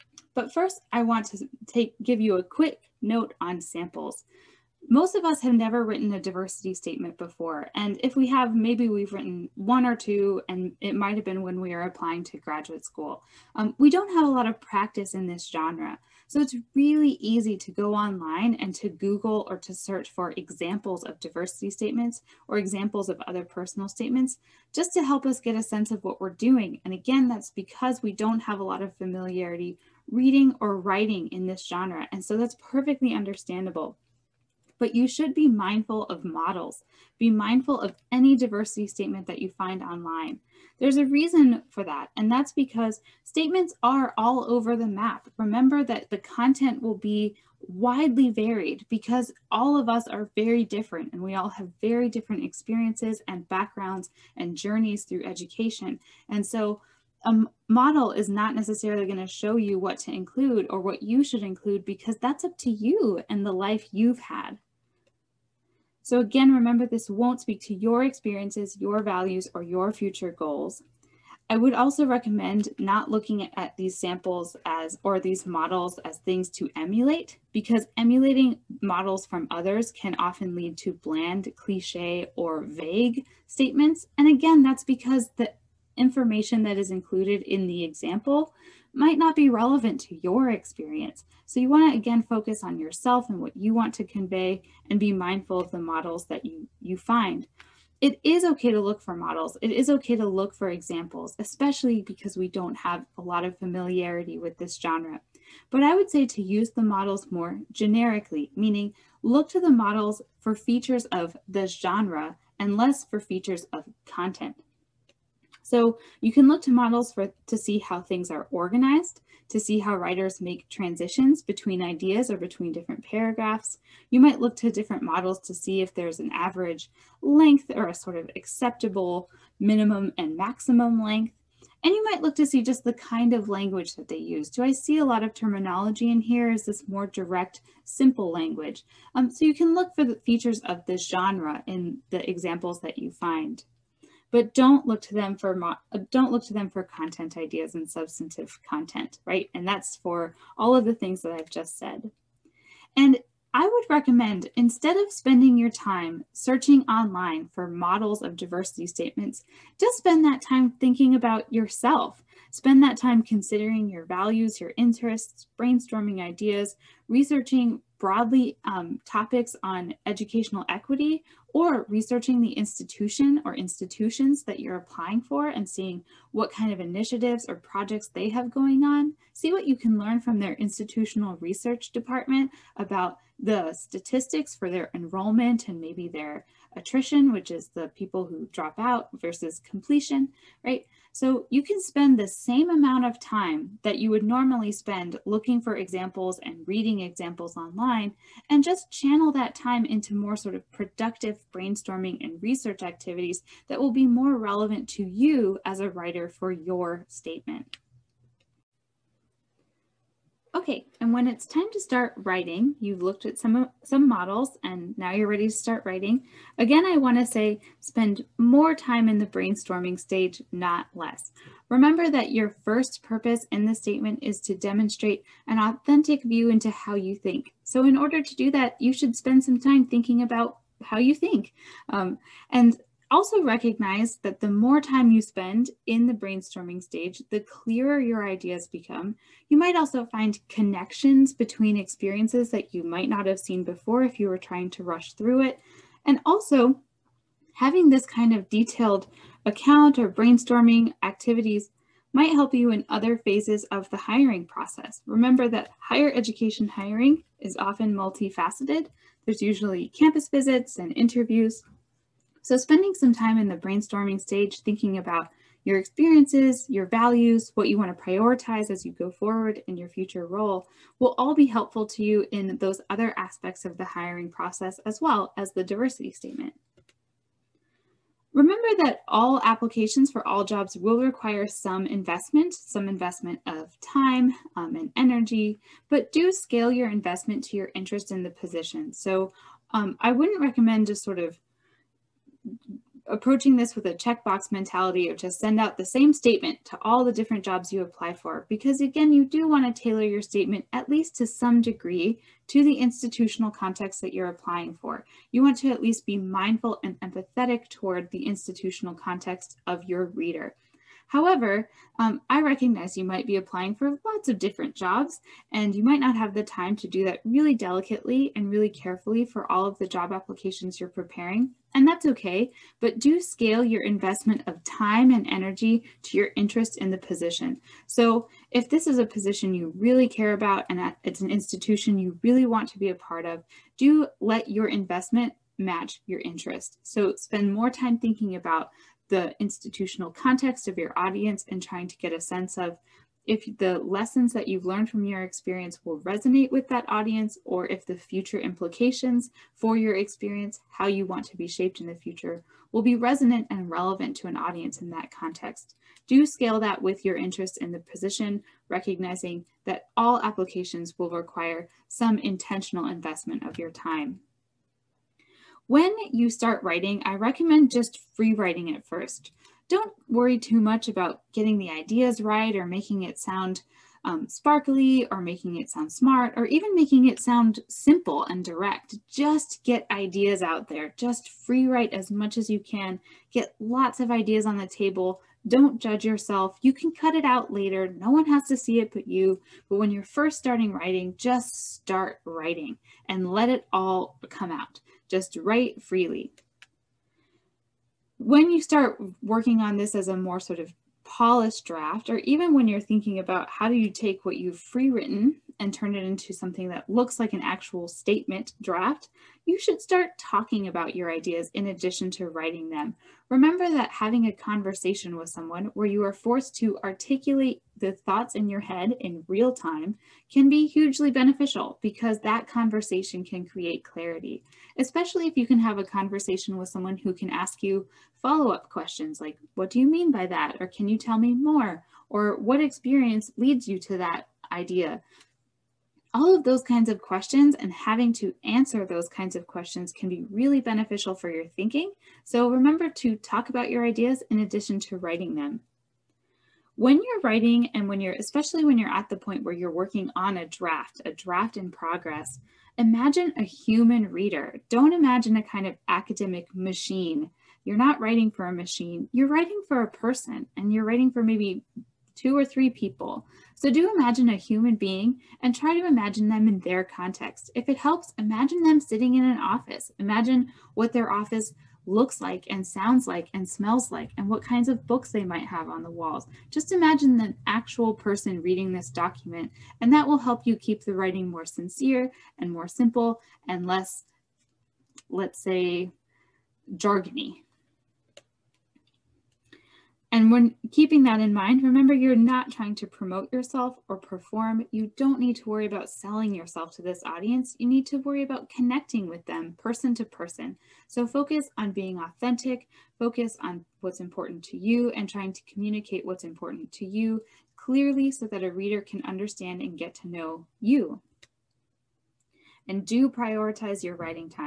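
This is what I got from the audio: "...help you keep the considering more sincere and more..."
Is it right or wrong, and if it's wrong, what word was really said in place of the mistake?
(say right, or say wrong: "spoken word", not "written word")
wrong: "writing", not "considering".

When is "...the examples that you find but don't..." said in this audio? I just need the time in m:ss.
2:22.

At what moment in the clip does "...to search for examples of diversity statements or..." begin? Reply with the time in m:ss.
0:19.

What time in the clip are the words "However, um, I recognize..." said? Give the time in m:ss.
5:11.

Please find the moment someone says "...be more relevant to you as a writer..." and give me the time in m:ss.
3:23.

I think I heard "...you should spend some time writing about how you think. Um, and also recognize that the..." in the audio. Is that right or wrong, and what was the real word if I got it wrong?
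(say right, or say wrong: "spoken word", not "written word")
wrong: "thinking", not "writing".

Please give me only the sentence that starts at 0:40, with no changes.
There's a reason for that, and that's because statements are all over the map.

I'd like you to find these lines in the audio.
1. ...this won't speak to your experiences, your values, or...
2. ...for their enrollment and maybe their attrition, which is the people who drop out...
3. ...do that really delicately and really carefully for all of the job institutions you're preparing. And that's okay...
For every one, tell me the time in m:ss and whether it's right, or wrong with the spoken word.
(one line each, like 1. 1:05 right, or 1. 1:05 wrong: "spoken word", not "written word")
1. 1:06 right
2. 3:04 right
3. 5:16 wrong: "applications", not "institutions".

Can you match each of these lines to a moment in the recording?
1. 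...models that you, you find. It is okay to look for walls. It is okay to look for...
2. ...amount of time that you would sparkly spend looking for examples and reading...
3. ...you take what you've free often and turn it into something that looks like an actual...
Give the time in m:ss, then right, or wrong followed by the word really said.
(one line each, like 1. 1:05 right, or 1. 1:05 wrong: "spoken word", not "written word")
1. 1:35 wrong: "models", not "walls"
2. 3:12 wrong: "normally", not "sparkly"
3. 6:43 wrong: "written", not "often".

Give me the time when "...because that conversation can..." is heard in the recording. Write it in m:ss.
7:01.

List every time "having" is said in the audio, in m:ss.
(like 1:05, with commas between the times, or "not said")
4:07, 6:53, 7:17.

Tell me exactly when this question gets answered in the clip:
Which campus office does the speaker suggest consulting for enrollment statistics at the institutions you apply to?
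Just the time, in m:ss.
3:00.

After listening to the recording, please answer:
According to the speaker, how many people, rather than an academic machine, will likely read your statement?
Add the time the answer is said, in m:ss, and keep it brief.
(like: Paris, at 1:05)
2 or 3, at 7:42.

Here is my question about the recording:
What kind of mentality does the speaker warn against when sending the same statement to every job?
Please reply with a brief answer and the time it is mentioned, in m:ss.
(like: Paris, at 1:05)
checkbox mentality, at 4:53.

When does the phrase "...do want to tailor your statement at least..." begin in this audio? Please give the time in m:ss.
4:59.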